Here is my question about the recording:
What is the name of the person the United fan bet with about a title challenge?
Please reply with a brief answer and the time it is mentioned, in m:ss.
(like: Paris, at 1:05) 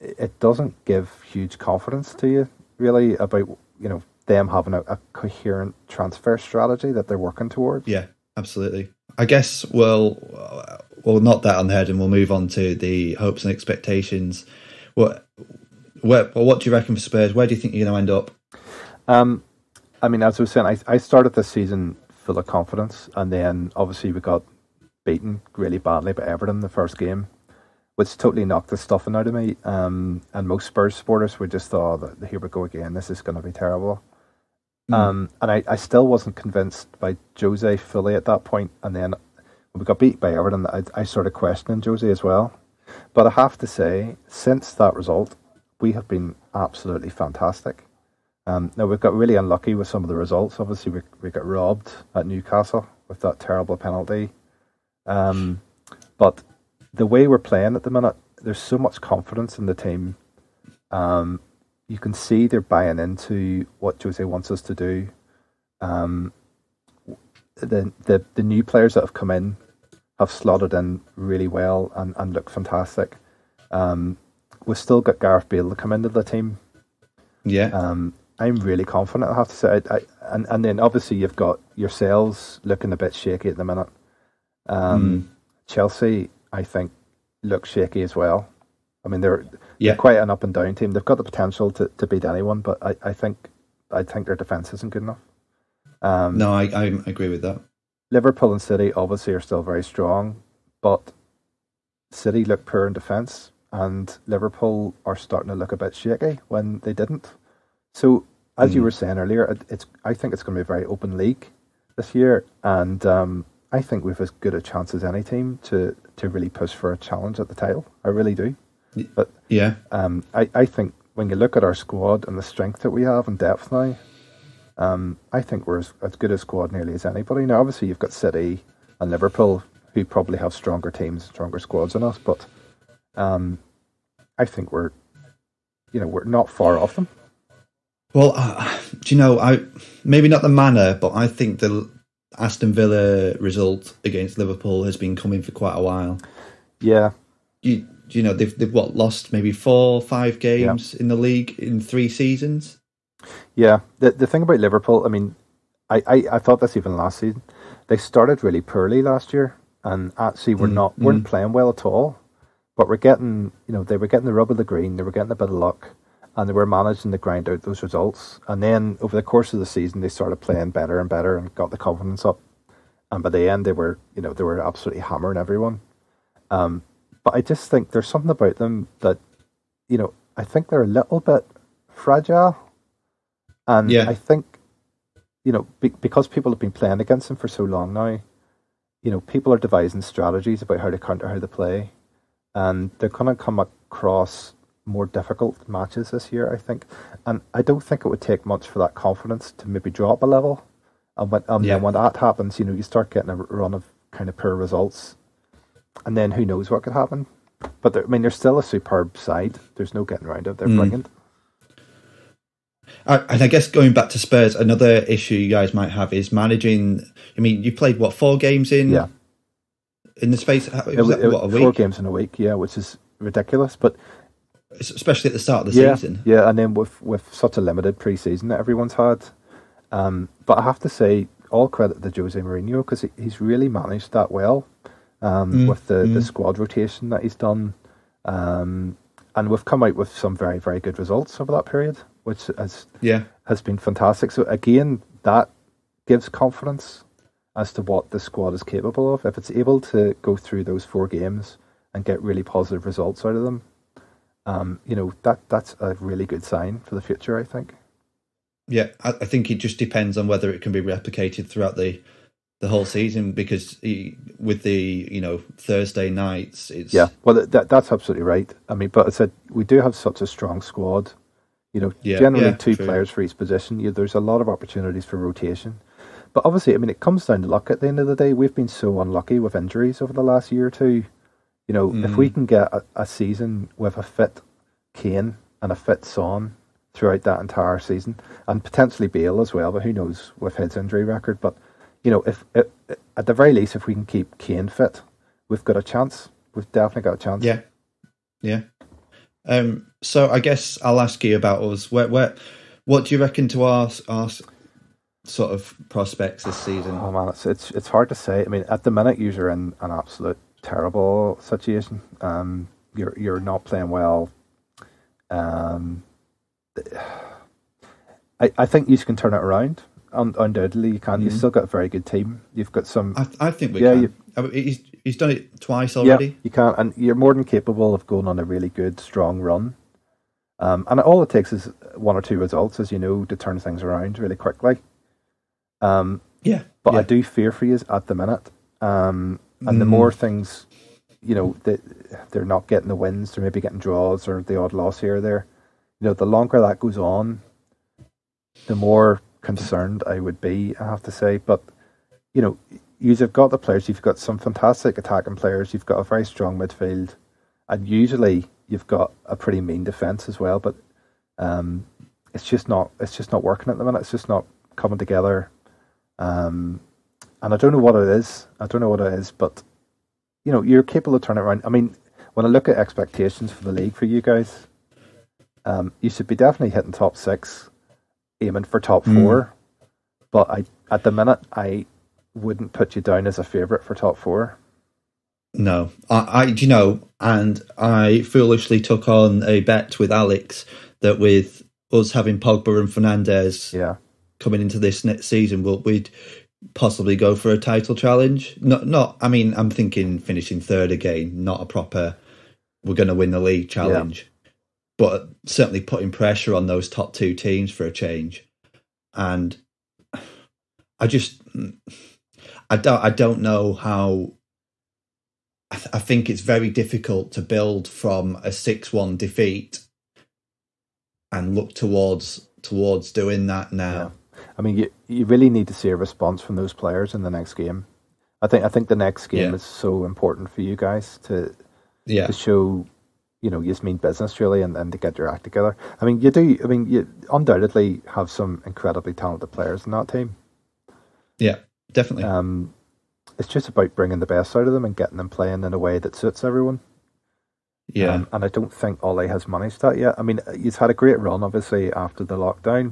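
Alex, at 6:30.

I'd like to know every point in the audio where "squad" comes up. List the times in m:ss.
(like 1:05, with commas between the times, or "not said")
2:01, 2:06, 2:11, 3:56, 4:08, 4:30.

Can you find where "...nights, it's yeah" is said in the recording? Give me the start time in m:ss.
4:26.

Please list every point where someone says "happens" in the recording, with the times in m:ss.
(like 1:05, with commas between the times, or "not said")
3:22, 3:26.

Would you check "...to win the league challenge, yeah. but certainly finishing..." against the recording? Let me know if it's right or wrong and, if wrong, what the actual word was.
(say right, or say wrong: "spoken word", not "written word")
wrong: "putting", not "finishing".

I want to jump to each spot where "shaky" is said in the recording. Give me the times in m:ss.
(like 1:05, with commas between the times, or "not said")
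1:23, 1:27, 1:45.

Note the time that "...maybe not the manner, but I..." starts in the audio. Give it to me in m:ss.
2:20.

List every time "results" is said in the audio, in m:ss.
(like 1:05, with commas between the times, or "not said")
0:44, 0:50, 2:23, 2:47, 3:24, 4:00, 4:12, 5:32.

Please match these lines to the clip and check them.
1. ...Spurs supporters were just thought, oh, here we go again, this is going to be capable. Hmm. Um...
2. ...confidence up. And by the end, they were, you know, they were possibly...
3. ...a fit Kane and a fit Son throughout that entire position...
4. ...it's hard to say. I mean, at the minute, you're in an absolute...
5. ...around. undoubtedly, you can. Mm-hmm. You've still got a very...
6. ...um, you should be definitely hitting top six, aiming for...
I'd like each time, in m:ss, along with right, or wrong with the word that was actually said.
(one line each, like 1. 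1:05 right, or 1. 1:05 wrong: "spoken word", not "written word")
1. 0:30 wrong: "terrible", not "capable"
2. 2:51 wrong: "absolutely", not "possibly"
3. 4:43 wrong: "season", not "position"
4. 5:07 right
5. 5:19 right
6. 6:15 right.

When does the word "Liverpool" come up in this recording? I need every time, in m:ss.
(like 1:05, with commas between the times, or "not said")
1:38, 1:44, 2:09, 2:24, 2:34.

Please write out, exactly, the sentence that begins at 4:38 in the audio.
We've been so unlucky with injuries over the last year or two.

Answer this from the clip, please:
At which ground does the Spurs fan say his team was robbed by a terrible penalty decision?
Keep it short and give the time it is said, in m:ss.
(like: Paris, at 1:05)
Newcastle, at 0:52.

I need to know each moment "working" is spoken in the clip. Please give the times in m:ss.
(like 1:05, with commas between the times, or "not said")
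0:07, 6:03.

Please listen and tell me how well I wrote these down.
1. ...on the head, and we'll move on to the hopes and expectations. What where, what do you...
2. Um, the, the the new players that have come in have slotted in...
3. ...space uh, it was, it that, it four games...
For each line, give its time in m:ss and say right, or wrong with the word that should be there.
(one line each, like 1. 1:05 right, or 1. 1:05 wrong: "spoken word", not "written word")
1. 0:11 right
2. 1:05 right
3. 3:40 right.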